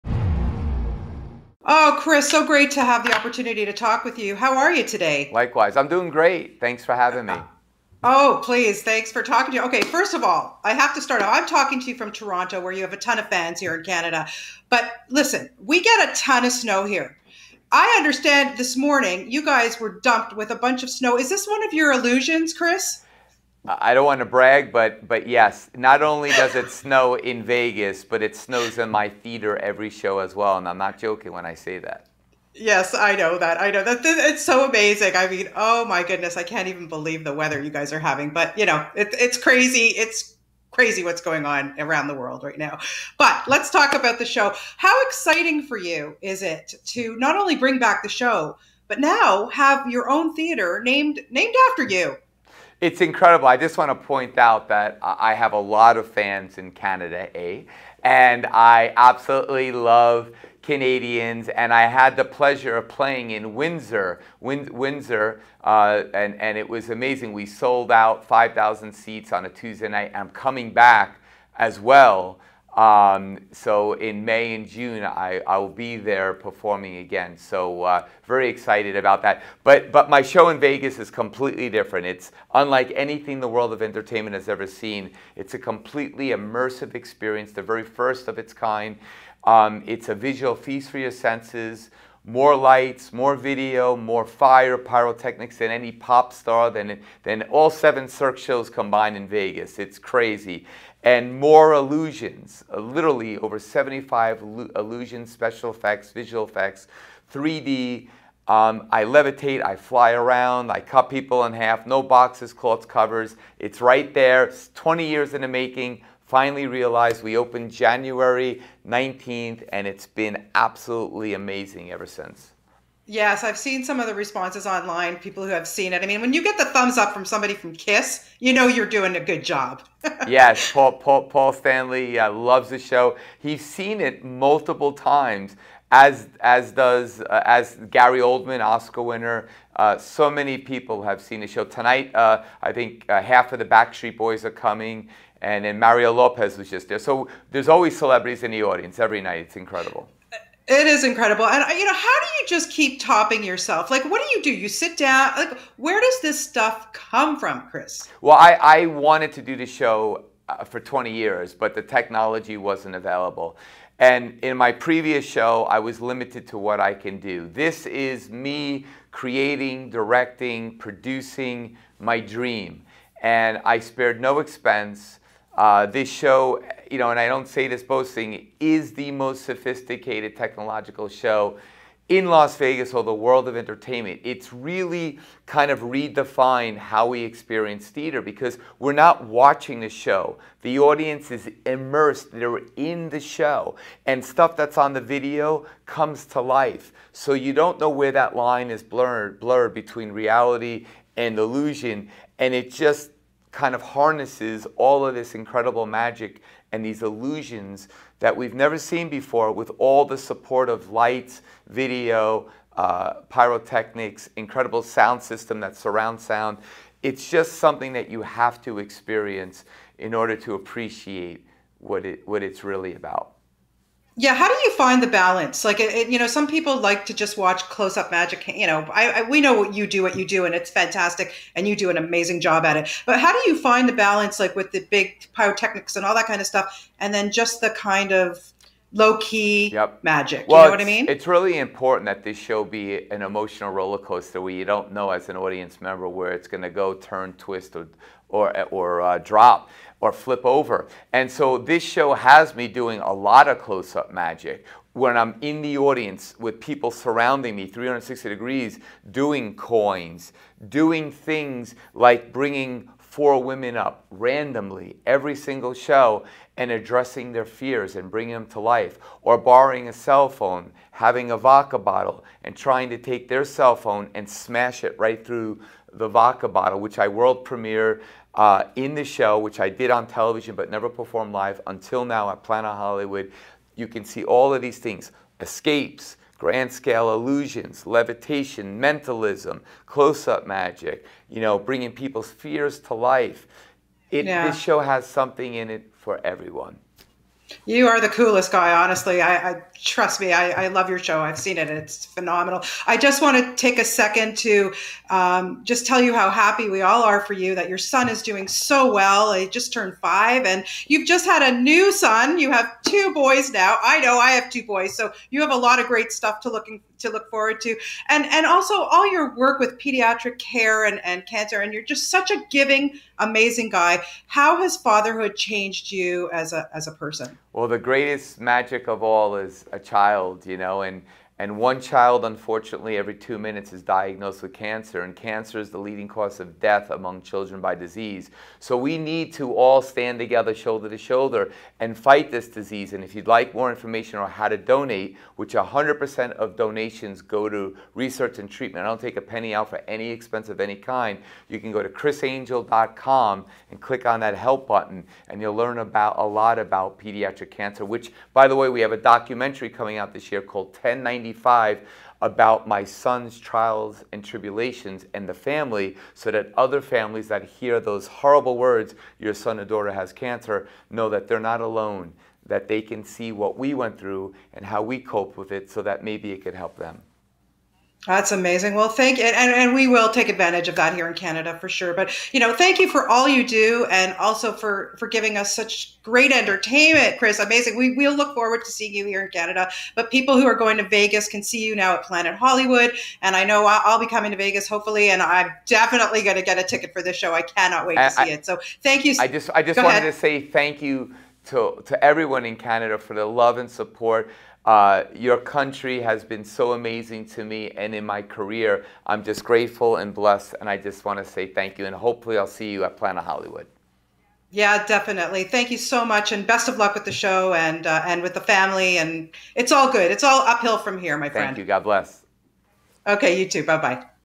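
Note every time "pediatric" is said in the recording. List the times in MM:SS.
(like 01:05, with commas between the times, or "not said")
05:19, 05:56.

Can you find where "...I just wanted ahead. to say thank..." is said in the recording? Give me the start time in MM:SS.
06:39.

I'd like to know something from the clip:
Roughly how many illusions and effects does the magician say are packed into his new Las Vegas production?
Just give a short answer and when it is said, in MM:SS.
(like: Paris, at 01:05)
over 75, at 01:43.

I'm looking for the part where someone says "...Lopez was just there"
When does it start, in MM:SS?
02:26.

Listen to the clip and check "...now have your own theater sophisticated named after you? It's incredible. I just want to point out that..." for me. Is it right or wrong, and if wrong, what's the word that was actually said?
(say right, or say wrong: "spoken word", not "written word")
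wrong: "named", not "sophisticated".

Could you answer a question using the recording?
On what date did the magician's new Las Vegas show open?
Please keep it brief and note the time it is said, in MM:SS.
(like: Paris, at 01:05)
January 19th, at 01:57.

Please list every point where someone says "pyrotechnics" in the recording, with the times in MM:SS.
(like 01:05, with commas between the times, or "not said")
01:34, 03:33, 03:55.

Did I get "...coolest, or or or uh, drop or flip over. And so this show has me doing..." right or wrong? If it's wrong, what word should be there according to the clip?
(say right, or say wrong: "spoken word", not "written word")
wrong: "twist", not "coolest".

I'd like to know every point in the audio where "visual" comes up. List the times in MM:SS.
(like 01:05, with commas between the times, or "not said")
01:30, 01:46.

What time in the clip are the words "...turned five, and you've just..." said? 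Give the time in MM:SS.
05:09.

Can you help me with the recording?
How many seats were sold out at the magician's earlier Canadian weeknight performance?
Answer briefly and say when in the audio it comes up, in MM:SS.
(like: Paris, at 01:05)
5,000, at 01:08.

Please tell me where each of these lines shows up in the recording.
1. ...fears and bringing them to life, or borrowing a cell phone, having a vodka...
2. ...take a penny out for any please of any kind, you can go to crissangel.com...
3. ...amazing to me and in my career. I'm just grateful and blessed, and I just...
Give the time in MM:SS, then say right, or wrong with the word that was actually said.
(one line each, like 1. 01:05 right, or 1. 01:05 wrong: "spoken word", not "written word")
1. 04:27 right
2. 05:49 wrong: "expense", not "please"
3. 06:46 right.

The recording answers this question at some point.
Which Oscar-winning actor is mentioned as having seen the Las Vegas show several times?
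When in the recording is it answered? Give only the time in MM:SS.
02:17.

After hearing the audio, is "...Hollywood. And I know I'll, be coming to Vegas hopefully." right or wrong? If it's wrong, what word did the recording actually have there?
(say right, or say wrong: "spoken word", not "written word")
right.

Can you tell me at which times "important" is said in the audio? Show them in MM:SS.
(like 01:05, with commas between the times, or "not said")
04:01.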